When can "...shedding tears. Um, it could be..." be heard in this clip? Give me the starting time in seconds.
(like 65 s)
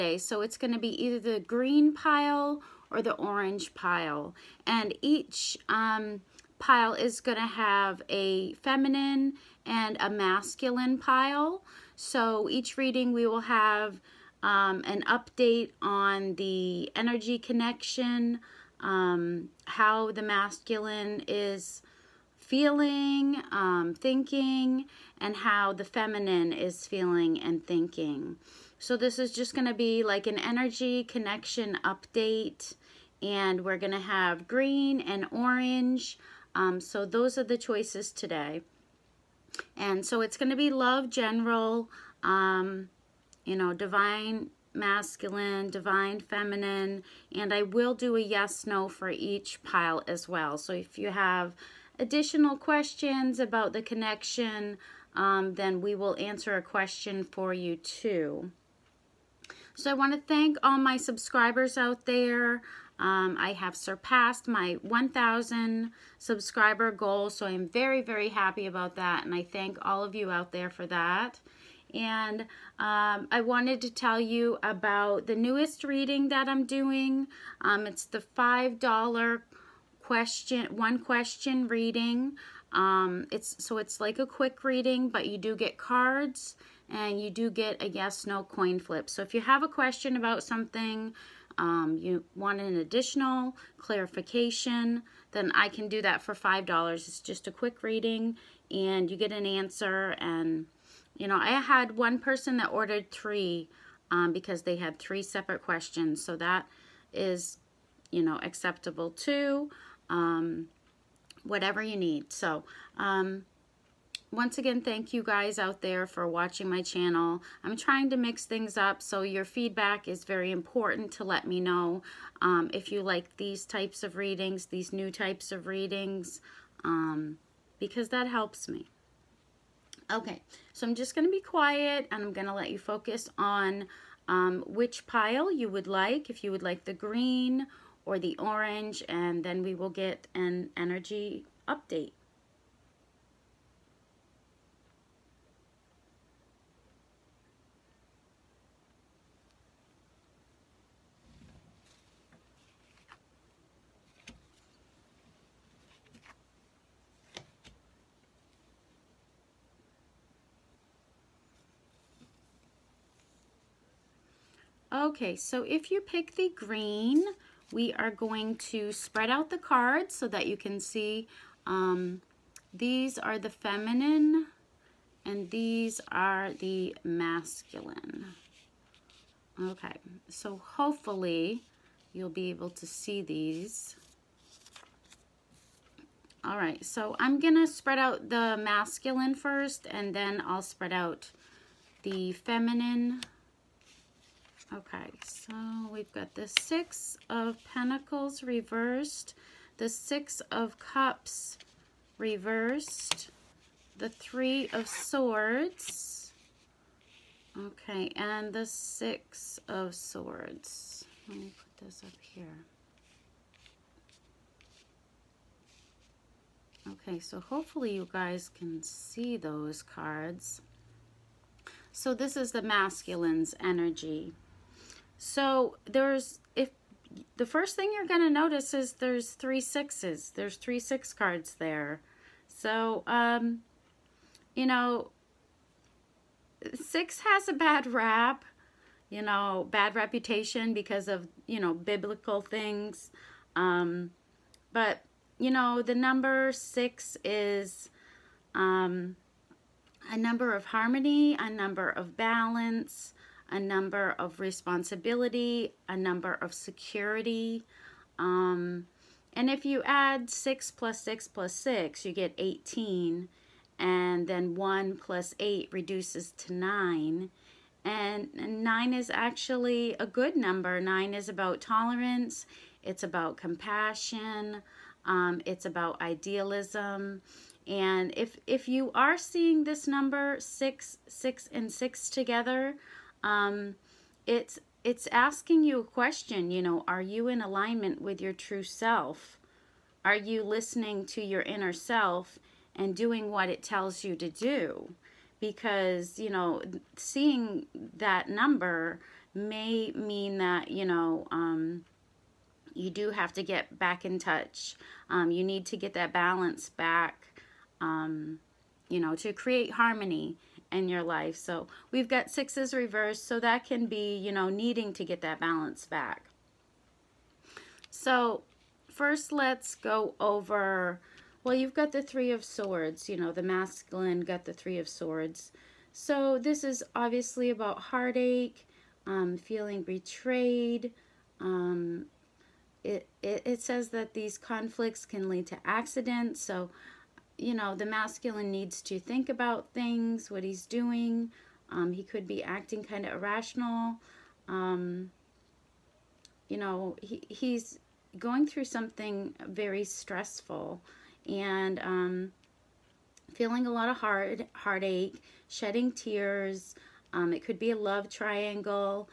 355 s.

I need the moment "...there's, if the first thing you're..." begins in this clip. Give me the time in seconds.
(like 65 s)
225 s.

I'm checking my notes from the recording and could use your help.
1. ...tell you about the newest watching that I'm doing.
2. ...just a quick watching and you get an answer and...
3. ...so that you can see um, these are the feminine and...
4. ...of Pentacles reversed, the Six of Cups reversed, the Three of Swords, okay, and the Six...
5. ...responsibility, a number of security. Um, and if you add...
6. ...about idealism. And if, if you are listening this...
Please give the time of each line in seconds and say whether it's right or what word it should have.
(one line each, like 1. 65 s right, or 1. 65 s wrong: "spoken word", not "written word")
1. 73 s wrong: "reading", not "watching"
2. 97 s wrong: "reading", not "watching"
3. 170 s right
4. 197 s right
5. 254 s right
6. 275 s wrong: "seeing", not "listening".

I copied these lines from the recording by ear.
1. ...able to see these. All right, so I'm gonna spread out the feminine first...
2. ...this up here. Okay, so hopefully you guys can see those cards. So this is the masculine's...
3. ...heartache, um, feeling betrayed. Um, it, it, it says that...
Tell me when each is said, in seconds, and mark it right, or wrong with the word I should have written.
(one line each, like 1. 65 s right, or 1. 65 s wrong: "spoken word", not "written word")
1. 182 s wrong: "masculine", not "feminine"
2. 211 s right
3. 327 s right.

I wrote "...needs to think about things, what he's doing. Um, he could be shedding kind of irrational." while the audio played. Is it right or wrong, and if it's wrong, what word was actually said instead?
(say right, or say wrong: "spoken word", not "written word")
wrong: "acting", not "shedding".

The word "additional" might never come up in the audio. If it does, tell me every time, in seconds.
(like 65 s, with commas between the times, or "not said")
51 s, 92 s.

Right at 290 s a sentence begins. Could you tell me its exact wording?
Are you listening to your inner self and doing what it tells you to do?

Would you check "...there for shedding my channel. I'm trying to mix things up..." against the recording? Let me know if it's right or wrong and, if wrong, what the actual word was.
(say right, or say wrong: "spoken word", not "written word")
wrong: "watching", not "shedding".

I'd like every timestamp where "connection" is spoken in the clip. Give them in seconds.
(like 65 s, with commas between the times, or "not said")
17 s, 31 s, 53 s.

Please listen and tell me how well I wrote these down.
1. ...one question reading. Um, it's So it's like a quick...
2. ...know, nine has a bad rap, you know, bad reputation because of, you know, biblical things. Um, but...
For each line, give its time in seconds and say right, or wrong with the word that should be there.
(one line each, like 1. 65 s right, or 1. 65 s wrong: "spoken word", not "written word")
1. 80 s right
2. 234 s wrong: "six", not "nine".